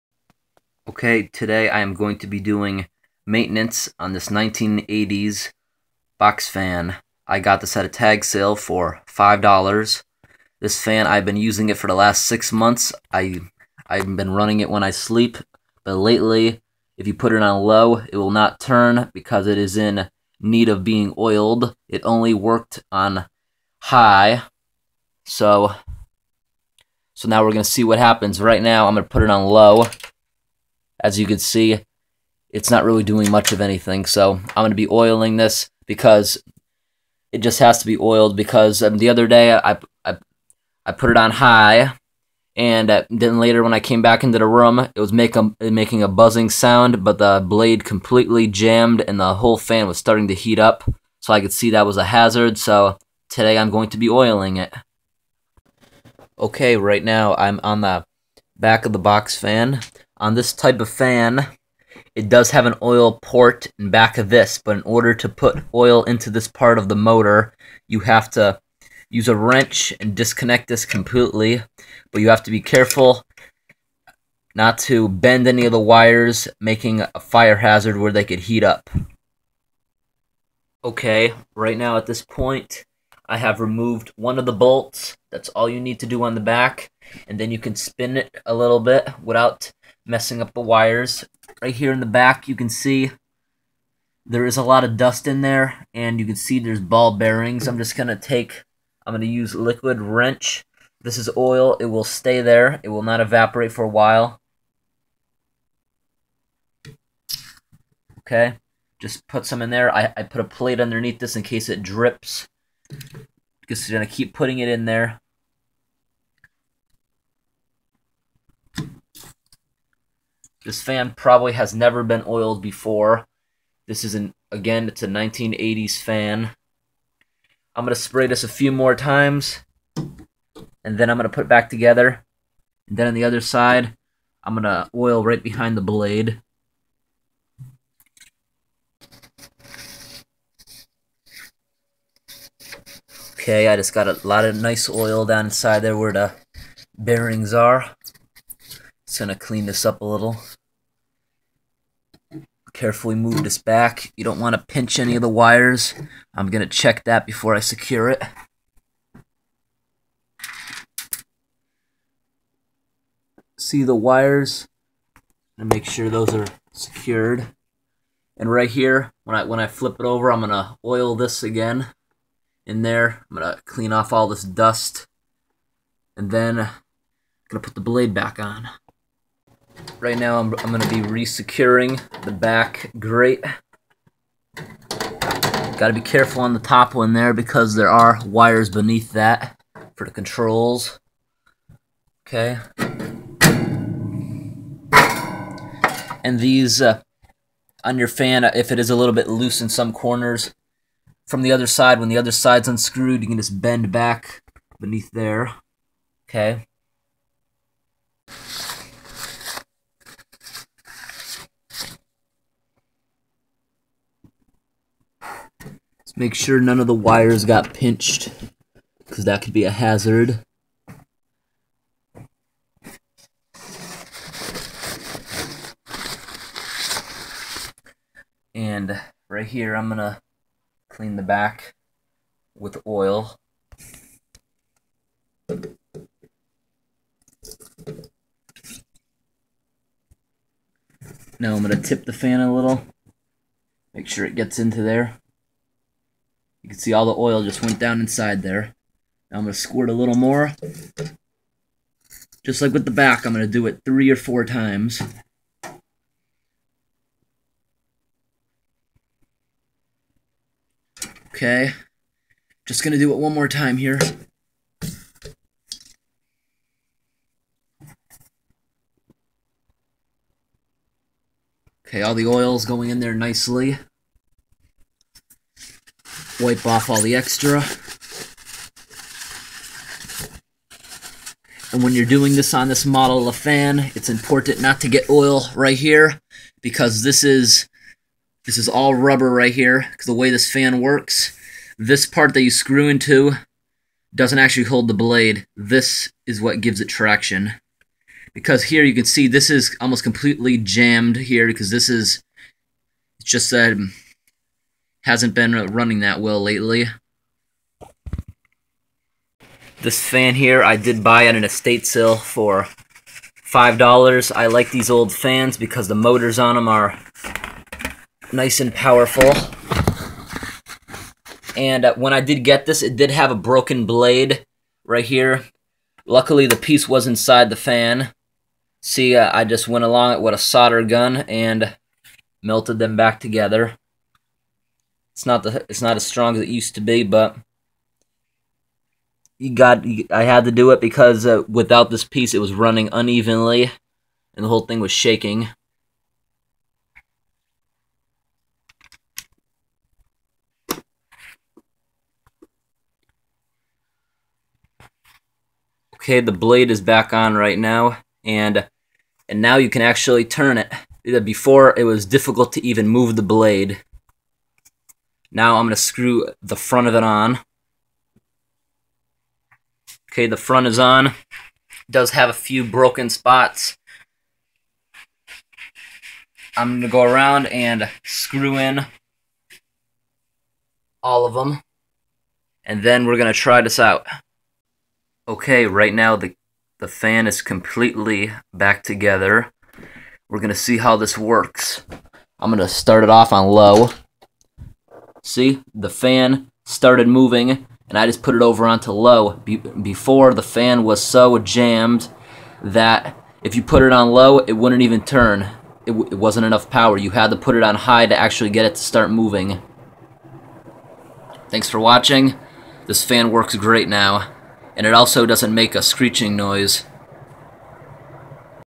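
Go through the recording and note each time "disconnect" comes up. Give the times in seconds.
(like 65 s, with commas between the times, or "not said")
70 s.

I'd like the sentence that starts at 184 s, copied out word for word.
Got to be careful on the top one there because there are wires beneath that for the controls.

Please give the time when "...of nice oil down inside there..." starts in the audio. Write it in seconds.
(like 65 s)
144 s.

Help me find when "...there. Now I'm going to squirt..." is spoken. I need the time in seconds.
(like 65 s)
248 s.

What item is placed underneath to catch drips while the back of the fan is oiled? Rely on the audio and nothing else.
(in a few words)
A plate.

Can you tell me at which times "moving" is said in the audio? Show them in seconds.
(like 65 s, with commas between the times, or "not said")
397 s, 409 s.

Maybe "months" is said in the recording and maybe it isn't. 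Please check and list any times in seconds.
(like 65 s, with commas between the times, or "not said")
12 s.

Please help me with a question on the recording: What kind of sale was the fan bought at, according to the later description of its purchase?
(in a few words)
Estate sale.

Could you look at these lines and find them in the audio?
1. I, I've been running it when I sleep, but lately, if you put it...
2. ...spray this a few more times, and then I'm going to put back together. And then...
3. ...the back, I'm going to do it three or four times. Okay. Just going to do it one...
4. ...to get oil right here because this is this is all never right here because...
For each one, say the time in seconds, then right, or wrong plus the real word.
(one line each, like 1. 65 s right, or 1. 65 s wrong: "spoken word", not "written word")
1. 13 s right
2. 127 s right
3. 252 s right
4. 284 s wrong: "rubber", not "never".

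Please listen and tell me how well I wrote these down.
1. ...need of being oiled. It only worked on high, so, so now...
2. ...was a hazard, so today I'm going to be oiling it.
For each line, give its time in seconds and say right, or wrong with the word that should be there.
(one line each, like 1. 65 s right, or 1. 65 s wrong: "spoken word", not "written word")
1. 20 s right
2. 51 s right.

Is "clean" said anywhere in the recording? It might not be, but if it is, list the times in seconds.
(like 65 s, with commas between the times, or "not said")
149 s, 173 s, 230 s.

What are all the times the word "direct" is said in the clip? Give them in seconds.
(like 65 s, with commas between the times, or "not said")
not said.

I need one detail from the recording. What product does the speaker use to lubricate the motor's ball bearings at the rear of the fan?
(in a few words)
Liquid Wrench.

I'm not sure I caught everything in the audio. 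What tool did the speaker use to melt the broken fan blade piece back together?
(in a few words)
Solder gun.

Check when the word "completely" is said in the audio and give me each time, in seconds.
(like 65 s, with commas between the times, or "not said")
47 s, 70 s, 300 s, 387 s.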